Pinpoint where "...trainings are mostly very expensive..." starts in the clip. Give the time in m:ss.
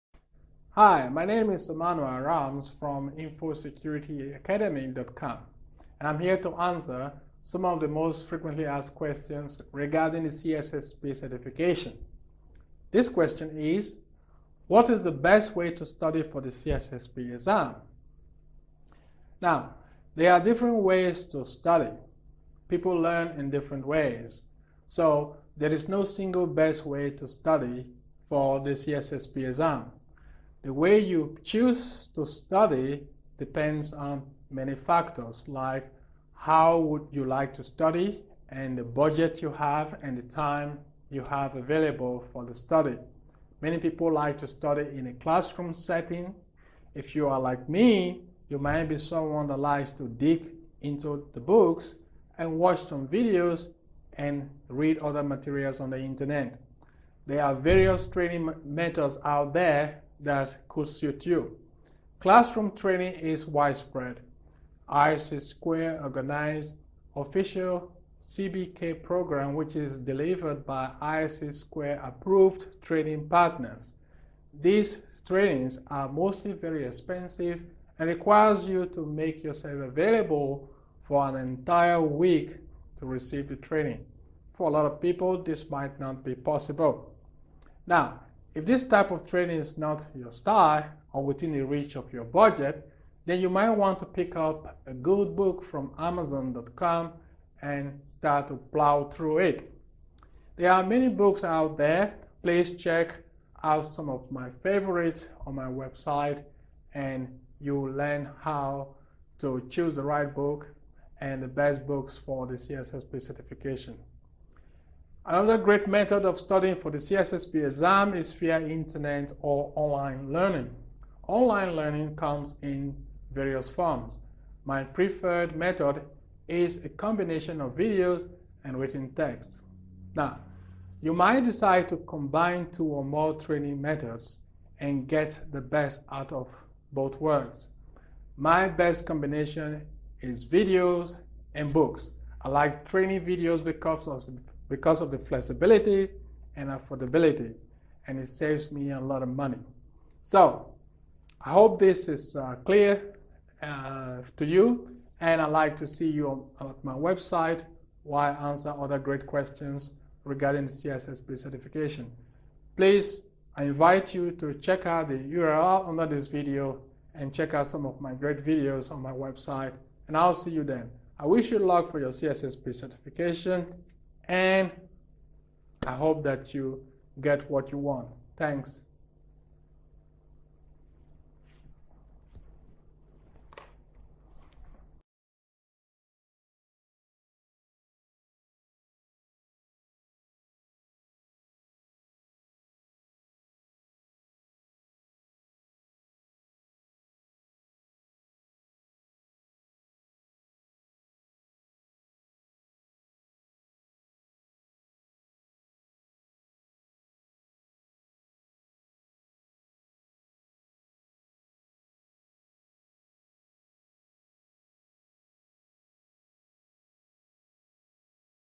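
1:15.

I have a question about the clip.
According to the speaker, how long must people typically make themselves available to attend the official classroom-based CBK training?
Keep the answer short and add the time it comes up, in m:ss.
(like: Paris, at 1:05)
An entire week, at 1:21.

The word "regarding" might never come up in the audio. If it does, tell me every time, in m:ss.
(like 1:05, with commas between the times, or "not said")
0:09, 2:40.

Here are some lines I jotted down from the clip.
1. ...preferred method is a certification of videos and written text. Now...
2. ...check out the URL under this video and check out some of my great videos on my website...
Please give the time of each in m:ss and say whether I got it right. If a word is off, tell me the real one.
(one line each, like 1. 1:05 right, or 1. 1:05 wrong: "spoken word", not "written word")
1. 2:04 wrong: "combination", not "certification"
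2. 2:44 right.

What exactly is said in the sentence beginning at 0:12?
This question is, what is the best way to study for the CISSP exam?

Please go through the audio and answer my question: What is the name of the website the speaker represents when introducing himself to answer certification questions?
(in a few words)
InfoSecurityAcademy.com.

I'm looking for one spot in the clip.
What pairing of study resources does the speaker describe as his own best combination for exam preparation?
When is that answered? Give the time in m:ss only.
2:20.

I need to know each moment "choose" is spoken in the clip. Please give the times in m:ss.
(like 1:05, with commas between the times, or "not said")
0:31, 1:49.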